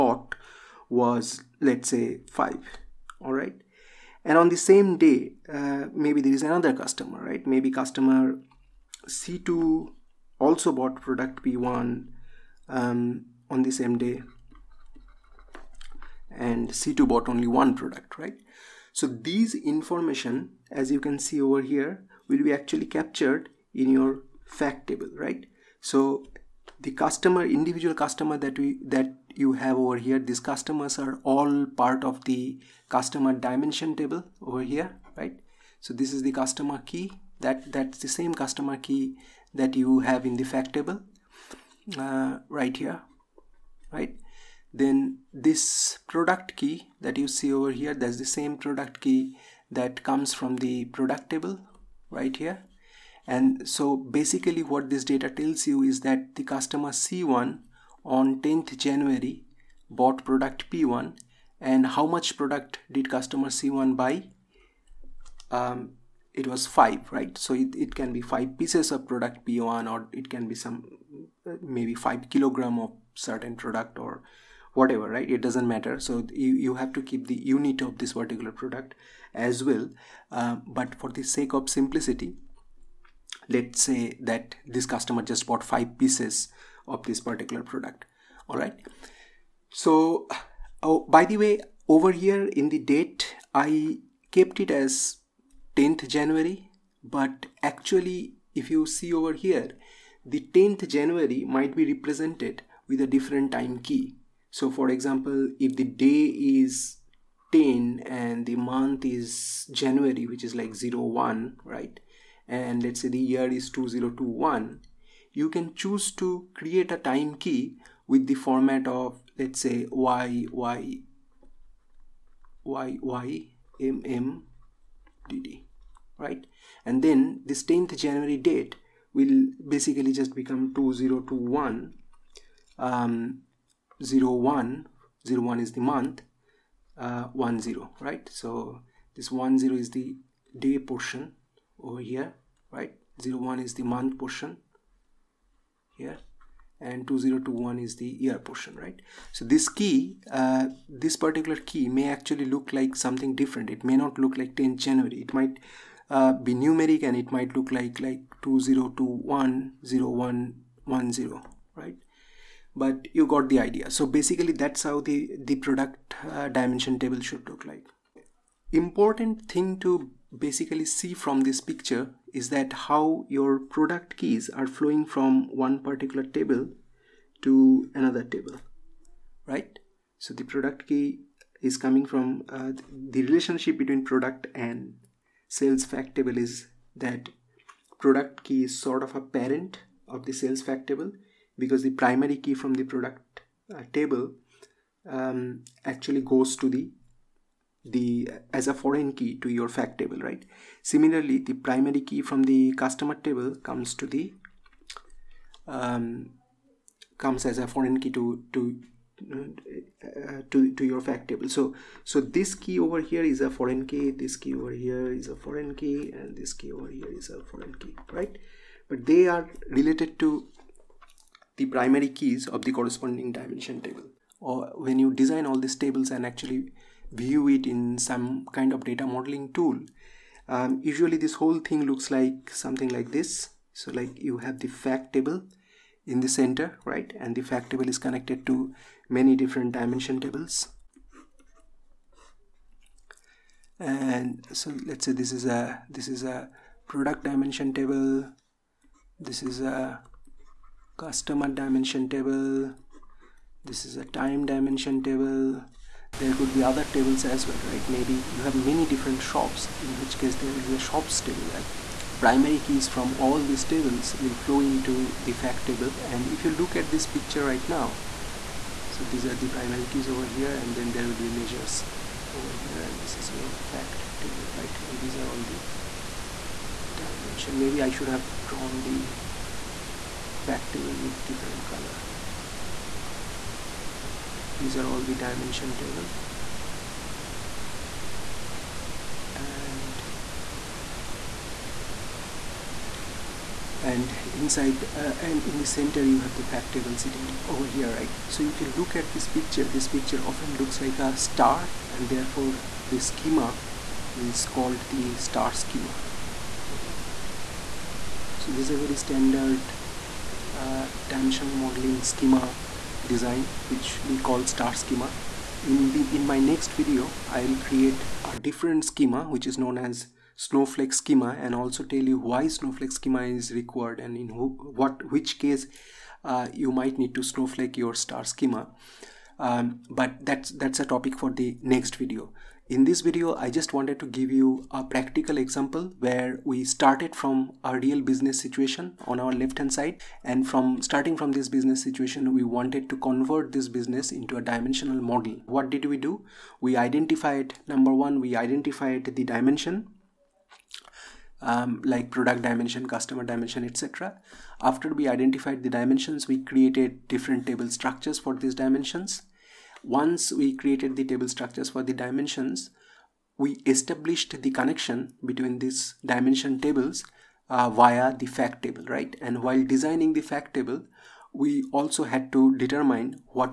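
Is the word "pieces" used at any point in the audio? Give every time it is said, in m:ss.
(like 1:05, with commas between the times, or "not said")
1:08, 1:25.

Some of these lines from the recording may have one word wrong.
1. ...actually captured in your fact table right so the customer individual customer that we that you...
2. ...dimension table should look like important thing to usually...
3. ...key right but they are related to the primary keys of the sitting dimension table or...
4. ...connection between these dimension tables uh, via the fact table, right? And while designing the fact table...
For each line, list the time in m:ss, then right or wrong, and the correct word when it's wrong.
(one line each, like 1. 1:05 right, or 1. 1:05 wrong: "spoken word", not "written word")
1. 0:22 right
2. 2:46 wrong: "basically", not "usually"
3. 3:37 wrong: "corresponding", not "sitting"
4. 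6:04 right.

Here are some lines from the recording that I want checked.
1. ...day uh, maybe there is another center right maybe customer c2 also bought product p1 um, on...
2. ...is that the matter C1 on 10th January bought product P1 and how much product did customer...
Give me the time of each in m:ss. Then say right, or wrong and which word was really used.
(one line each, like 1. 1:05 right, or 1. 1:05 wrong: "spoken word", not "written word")
1. 0:04 wrong: "customer", not "center"
2. 0:55 wrong: "customer", not "matter".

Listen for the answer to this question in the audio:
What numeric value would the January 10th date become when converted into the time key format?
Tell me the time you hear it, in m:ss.
2:38.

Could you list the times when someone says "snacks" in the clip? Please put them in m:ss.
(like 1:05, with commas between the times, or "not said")
not said.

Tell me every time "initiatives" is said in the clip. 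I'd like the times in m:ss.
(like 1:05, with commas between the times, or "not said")
not said.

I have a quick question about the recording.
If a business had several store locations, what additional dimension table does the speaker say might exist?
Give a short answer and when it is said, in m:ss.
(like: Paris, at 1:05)
shops table, at 4:20.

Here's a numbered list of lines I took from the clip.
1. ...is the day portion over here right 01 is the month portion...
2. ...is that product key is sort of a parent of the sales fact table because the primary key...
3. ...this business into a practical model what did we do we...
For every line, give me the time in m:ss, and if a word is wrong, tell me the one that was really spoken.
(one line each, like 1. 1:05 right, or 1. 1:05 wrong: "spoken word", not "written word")
1. 2:19 right
2. 3:06 right
3. 5:43 wrong: "dimensional", not "practical".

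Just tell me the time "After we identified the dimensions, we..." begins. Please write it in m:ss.
5:54.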